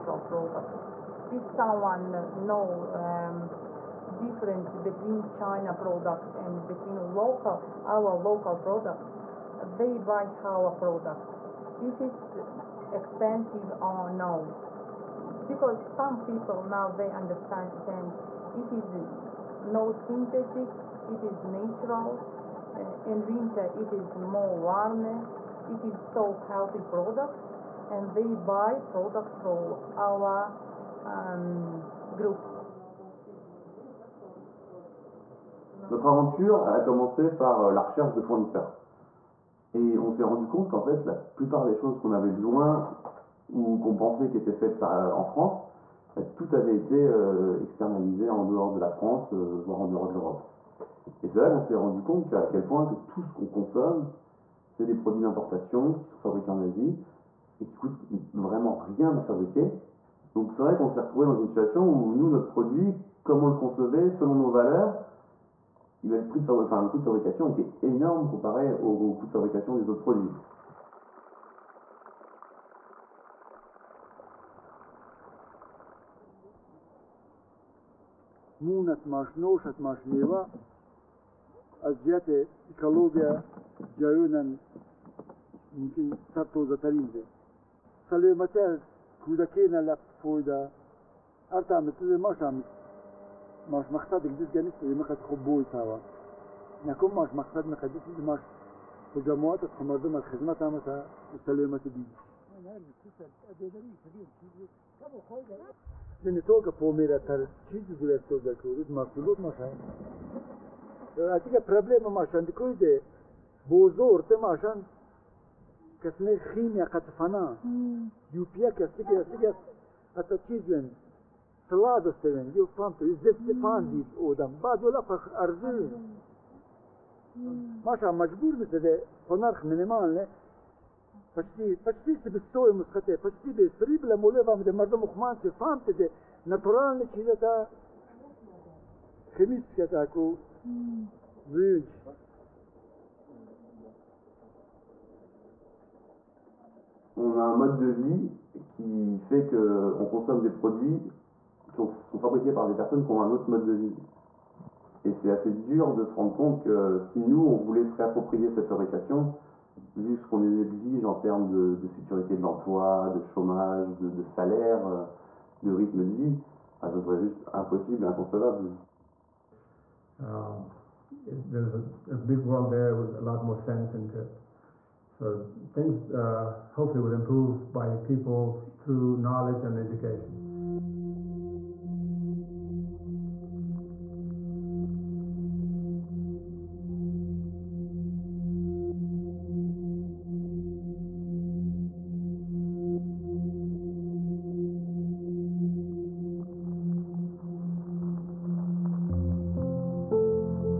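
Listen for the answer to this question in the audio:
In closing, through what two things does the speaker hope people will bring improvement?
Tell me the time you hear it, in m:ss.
2:59.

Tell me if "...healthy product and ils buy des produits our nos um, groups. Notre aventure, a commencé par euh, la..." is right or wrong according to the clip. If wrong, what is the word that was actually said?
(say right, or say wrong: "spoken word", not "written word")
right.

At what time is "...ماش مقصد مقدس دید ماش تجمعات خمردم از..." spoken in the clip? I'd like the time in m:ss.
1:37.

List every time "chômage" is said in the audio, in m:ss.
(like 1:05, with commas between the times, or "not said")
2:43.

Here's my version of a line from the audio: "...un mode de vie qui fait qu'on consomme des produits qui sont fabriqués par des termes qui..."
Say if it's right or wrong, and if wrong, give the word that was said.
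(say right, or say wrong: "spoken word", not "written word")
wrong: "personnes", not "termes".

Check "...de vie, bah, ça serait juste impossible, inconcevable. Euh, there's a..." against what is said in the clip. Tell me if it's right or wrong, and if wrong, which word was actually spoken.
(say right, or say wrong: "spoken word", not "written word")
right.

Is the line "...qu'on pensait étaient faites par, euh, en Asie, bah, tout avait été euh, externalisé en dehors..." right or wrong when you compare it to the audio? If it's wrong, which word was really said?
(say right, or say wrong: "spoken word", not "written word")
wrong: "France", not "Asie".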